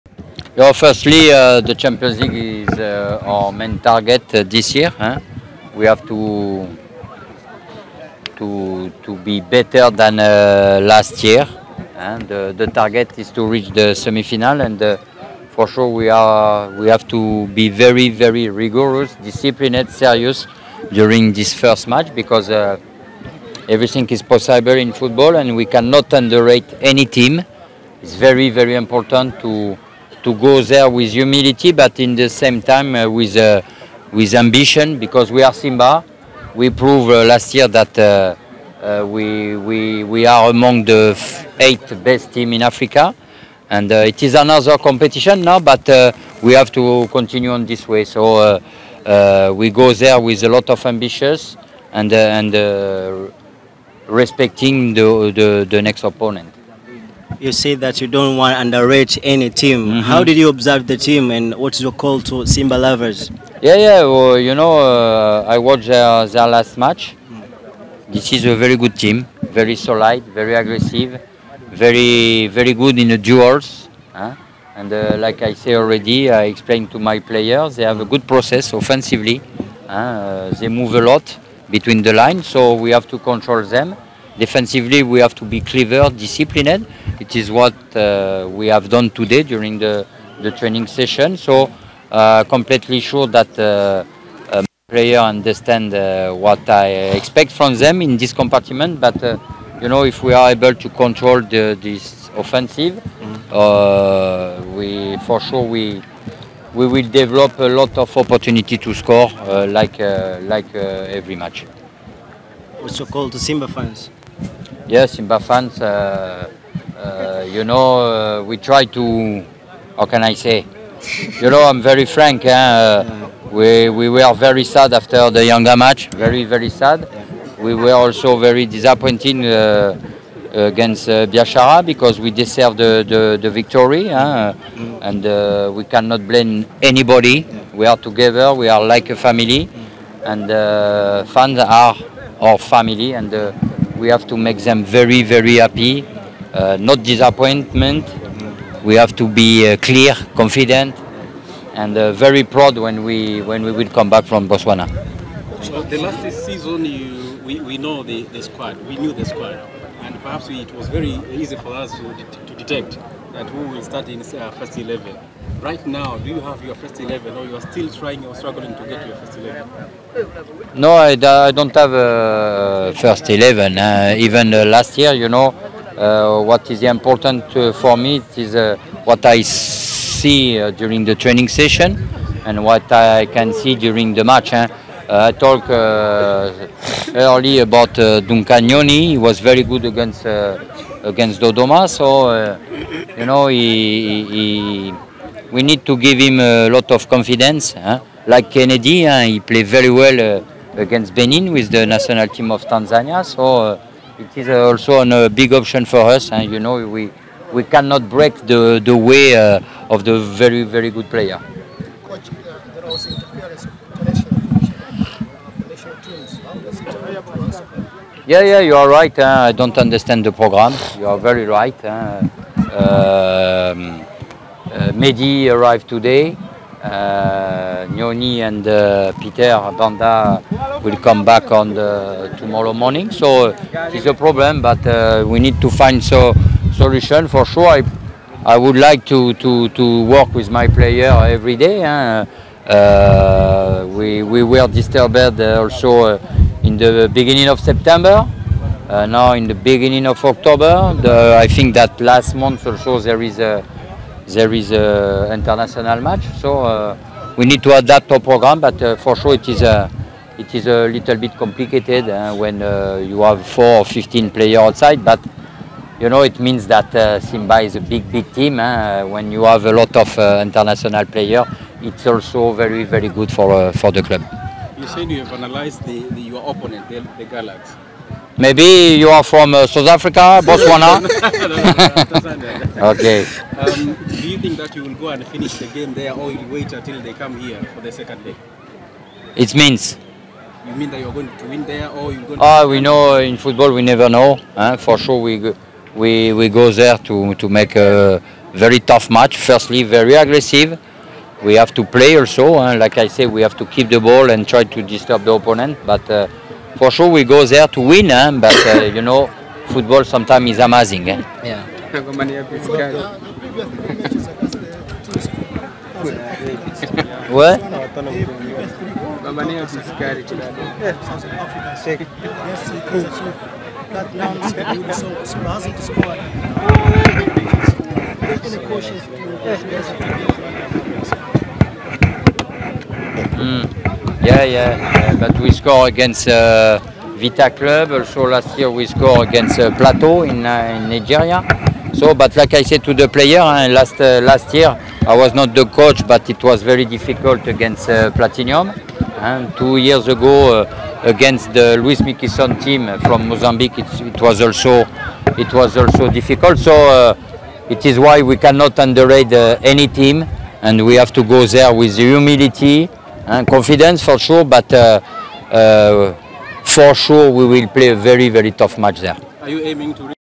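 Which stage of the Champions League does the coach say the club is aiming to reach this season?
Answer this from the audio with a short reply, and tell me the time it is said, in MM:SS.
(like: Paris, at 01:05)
semi-final, at 00:13.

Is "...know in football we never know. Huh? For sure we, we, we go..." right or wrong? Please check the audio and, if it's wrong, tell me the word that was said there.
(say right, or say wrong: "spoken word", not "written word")
right.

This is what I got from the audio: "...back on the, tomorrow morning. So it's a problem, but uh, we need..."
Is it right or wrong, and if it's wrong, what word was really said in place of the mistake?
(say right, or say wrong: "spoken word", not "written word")
right.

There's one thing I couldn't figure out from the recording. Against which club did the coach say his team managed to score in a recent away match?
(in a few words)
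Vita Club.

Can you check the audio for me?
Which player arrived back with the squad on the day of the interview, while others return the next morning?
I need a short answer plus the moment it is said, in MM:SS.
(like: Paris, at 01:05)
Meddie, at 03:44.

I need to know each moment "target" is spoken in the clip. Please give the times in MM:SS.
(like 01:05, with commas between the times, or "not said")
00:03, 00:12.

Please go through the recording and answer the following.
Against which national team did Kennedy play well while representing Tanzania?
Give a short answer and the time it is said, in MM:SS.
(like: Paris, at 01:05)
Benin, at 03:21.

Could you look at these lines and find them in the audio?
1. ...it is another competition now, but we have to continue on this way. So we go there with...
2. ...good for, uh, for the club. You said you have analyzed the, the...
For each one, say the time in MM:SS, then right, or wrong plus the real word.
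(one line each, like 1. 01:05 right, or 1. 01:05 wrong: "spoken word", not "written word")
1. 00:44 right
2. 04:33 right.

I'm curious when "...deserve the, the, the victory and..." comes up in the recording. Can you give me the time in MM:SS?
02:12.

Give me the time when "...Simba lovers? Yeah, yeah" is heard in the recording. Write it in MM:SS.
01:02.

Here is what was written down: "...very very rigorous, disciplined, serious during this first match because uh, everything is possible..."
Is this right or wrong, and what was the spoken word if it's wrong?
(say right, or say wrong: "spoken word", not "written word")
right.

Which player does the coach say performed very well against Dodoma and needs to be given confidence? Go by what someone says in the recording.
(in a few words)
Duncan Nyoni.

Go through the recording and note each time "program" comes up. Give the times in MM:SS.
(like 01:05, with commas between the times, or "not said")
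03:40, 04:18.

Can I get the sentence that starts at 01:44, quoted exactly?
we for sure we we will develop a lot of opportunity to score uh, like uh, like uh, every match.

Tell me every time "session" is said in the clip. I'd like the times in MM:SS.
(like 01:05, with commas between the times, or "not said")
01:30, 03:01.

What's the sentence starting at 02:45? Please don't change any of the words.
Right now, do you have your first 11 or you are still trying or struggling to get your first 11?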